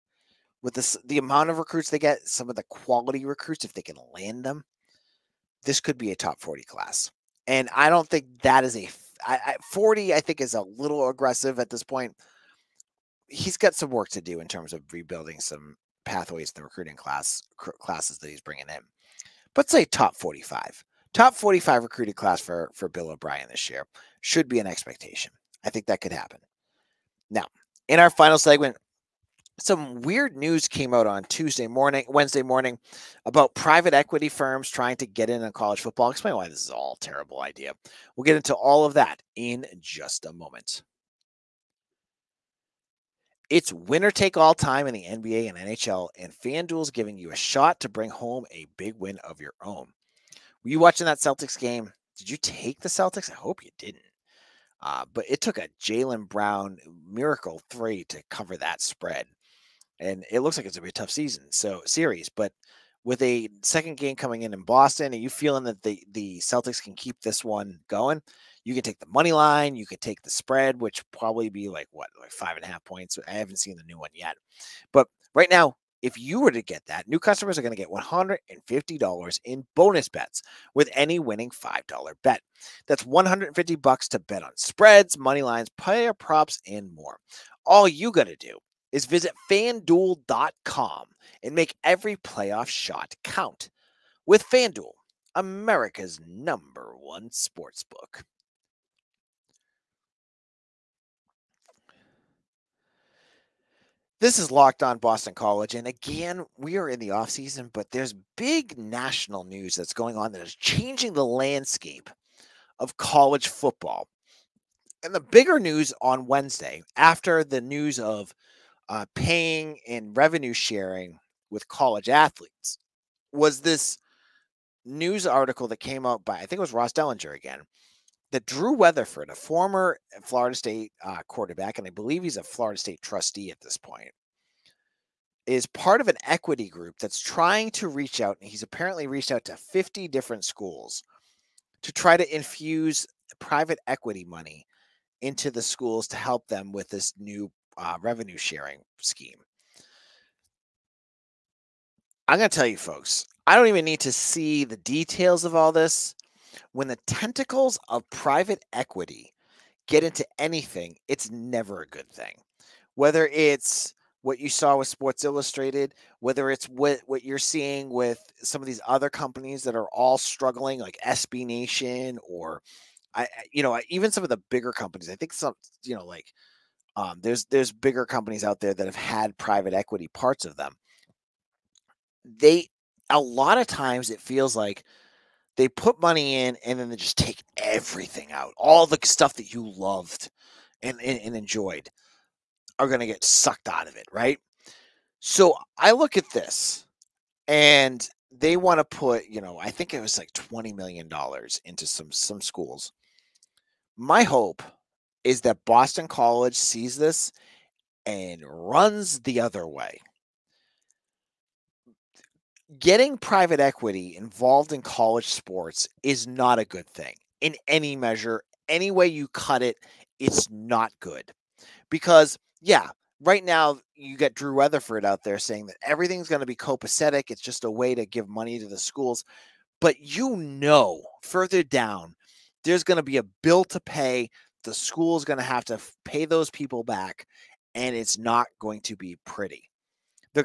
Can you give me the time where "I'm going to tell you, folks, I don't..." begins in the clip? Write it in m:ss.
2:32.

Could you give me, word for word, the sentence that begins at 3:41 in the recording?
Because, yeah, right now you get Drew Weatherford out there saying that everything's going to be copacetic.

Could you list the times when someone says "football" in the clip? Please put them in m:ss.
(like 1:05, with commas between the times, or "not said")
0:35, 1:53.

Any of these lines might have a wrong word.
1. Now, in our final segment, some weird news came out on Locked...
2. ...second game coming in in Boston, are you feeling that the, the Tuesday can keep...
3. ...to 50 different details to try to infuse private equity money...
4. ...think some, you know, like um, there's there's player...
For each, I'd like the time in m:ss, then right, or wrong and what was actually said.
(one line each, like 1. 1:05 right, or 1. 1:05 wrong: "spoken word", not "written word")
1. 0:27 wrong: "Tuesday", not "Locked"
2. 1:03 wrong: "Celtics", not "Tuesday"
3. 2:19 wrong: "schools", not "details"
4. 2:55 wrong: "bigger", not "player".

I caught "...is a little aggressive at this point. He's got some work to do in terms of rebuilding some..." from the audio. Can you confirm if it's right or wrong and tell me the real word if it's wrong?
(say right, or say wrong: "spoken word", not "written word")
right.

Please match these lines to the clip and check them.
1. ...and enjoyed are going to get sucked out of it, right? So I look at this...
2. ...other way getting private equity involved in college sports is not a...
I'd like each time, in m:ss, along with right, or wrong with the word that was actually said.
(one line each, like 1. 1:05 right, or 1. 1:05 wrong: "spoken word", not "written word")
1. 3:11 right
2. 3:29 right.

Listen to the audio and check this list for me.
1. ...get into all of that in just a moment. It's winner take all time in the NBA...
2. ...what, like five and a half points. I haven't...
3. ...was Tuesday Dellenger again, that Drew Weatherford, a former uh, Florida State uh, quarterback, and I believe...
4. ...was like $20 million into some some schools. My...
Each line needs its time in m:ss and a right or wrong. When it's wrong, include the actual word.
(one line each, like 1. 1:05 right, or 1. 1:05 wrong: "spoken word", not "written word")
1. 0:38 right
2. 1:11 right
3. 2:06 wrong: "Ross", not "Tuesday"
4. 3:19 right.